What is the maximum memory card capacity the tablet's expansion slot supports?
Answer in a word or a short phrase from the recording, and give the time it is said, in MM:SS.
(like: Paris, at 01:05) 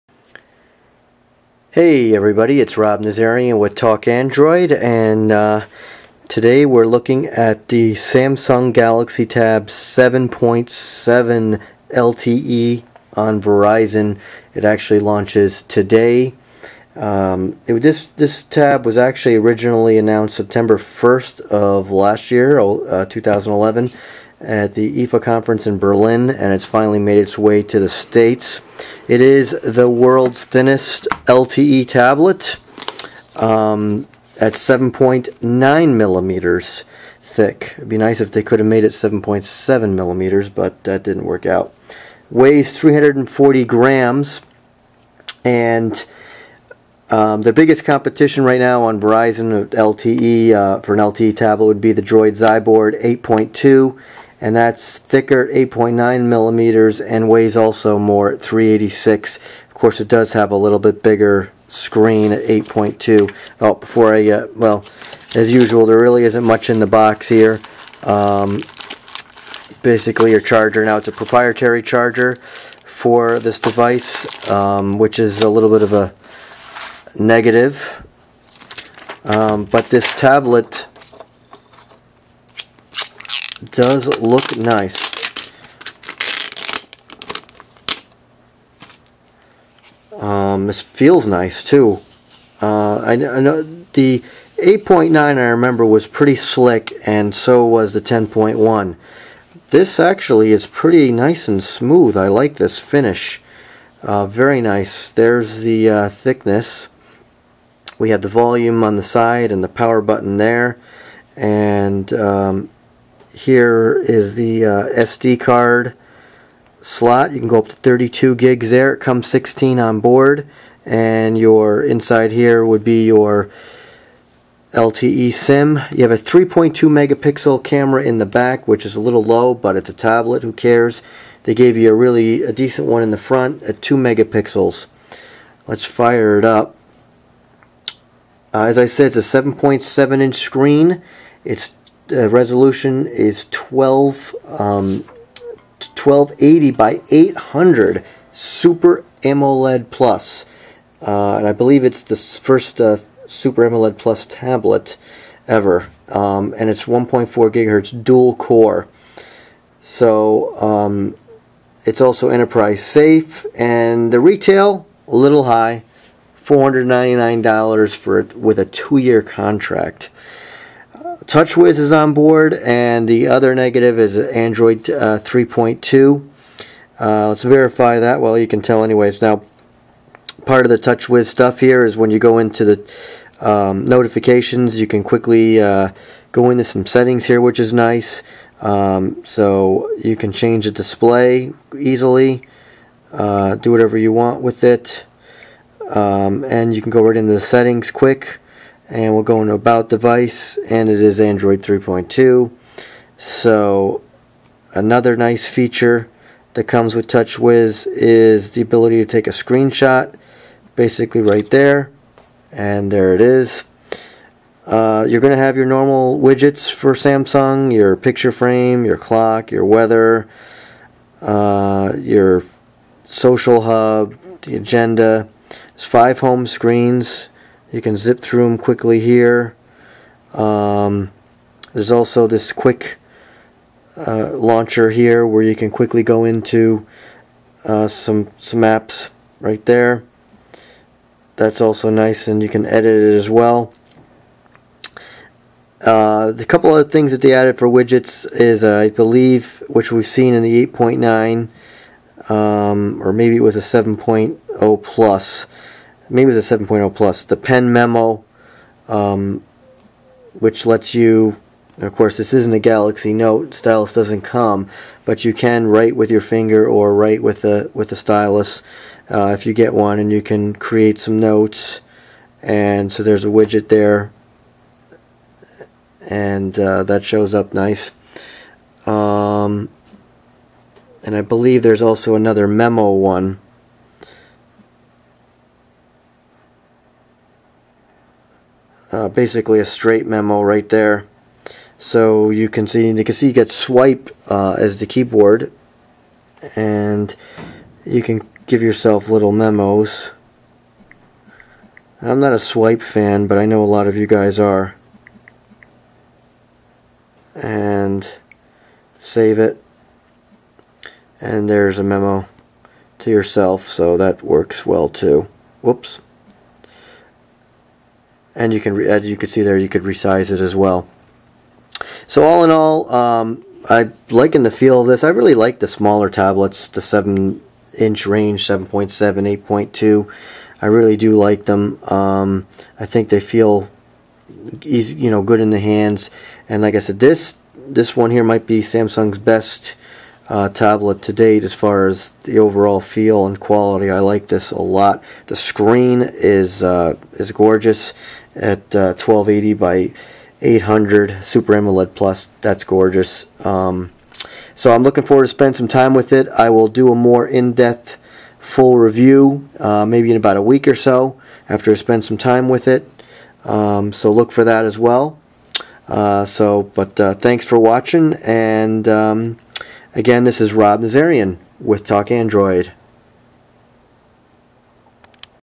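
32 gigs, at 01:57.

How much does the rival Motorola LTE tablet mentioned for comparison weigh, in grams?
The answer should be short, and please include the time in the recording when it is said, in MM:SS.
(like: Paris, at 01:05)
386, at 00:58.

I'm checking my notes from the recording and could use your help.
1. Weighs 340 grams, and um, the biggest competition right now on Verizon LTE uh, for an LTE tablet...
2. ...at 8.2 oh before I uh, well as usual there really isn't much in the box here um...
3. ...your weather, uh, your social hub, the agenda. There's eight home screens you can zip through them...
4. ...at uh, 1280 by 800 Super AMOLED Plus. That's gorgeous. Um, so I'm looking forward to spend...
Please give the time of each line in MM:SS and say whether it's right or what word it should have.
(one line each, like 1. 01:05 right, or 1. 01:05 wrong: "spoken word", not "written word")
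1. 00:42 right
2. 01:02 right
3. 03:39 wrong: "five", not "eight"
4. 05:48 right.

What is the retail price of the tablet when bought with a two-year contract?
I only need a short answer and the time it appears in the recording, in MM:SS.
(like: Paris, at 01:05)
$499, at 02:46.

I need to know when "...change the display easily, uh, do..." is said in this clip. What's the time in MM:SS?
03:10.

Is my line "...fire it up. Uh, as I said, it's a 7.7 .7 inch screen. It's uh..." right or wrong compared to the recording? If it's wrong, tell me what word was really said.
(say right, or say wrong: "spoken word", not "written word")
right.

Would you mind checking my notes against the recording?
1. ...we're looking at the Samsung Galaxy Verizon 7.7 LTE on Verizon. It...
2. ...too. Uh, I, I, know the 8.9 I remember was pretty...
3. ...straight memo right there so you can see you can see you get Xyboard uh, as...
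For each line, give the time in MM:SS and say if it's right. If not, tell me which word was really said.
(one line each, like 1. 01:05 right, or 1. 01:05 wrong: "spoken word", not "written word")
1. 00:06 wrong: "Tab", not "Verizon"
2. 01:31 right
3. 04:49 wrong: "Swype", not "Xyboard".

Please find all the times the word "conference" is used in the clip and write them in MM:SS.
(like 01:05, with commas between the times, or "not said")
00:25.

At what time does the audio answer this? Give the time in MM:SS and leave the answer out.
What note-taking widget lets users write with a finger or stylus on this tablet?
04:17.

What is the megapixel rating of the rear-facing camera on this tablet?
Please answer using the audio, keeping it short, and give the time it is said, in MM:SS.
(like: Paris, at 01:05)
3.2 megapixels, at 02:06.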